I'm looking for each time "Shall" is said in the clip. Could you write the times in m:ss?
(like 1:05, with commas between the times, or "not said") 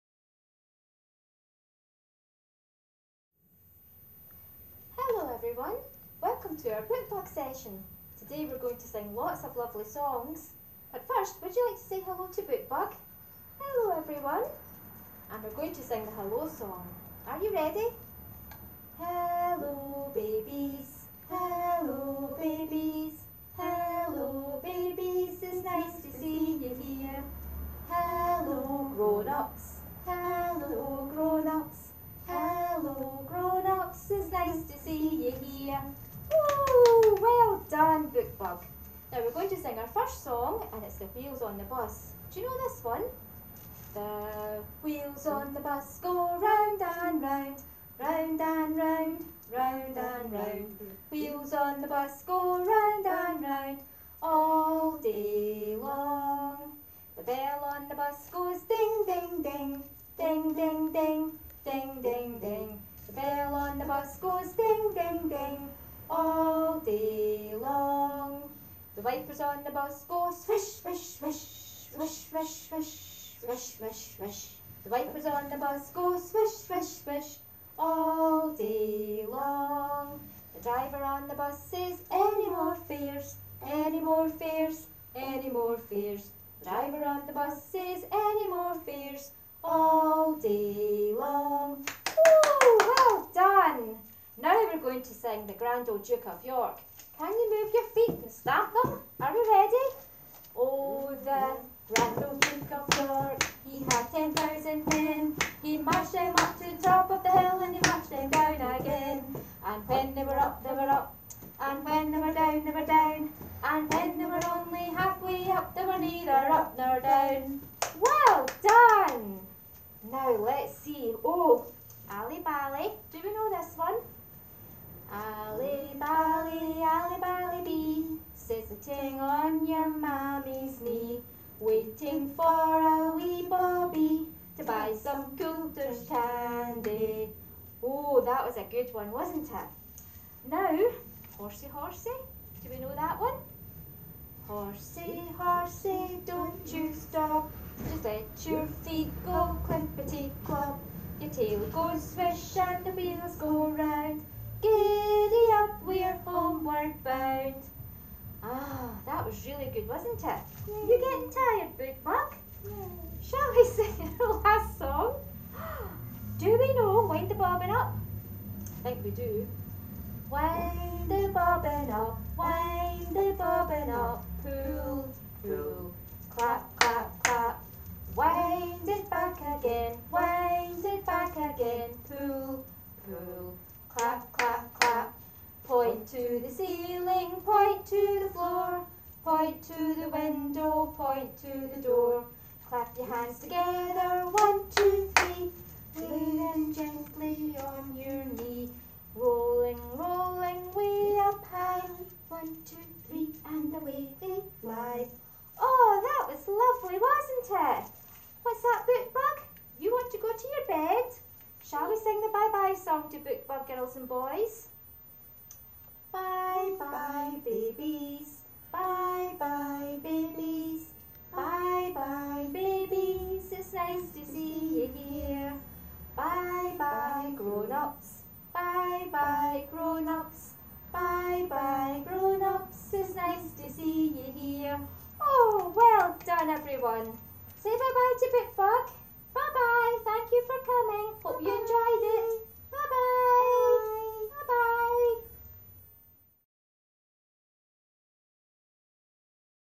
2:43, 3:31.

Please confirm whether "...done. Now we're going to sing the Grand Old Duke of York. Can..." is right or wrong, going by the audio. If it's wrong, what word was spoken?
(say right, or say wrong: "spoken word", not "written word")
right.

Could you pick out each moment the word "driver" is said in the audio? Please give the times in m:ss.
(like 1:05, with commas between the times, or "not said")
1:20, 1:26.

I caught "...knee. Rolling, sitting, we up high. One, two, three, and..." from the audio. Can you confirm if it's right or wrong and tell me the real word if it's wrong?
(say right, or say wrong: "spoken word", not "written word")
wrong: "rolling", not "sitting".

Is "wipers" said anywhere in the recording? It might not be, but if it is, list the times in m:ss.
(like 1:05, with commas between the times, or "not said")
1:09, 1:14.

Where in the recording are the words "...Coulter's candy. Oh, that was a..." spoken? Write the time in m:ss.
2:15.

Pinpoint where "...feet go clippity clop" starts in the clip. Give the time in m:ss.
2:28.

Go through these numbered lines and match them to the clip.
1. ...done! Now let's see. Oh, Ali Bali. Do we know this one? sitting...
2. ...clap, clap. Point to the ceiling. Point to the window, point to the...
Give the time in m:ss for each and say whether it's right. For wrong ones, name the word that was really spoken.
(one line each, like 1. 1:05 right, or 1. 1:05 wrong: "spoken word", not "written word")
1. 1:58 right
2. 3:04 right.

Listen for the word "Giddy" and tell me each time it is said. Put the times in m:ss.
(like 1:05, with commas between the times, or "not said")
2:34.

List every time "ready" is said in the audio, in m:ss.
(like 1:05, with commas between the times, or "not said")
0:17, 1:39.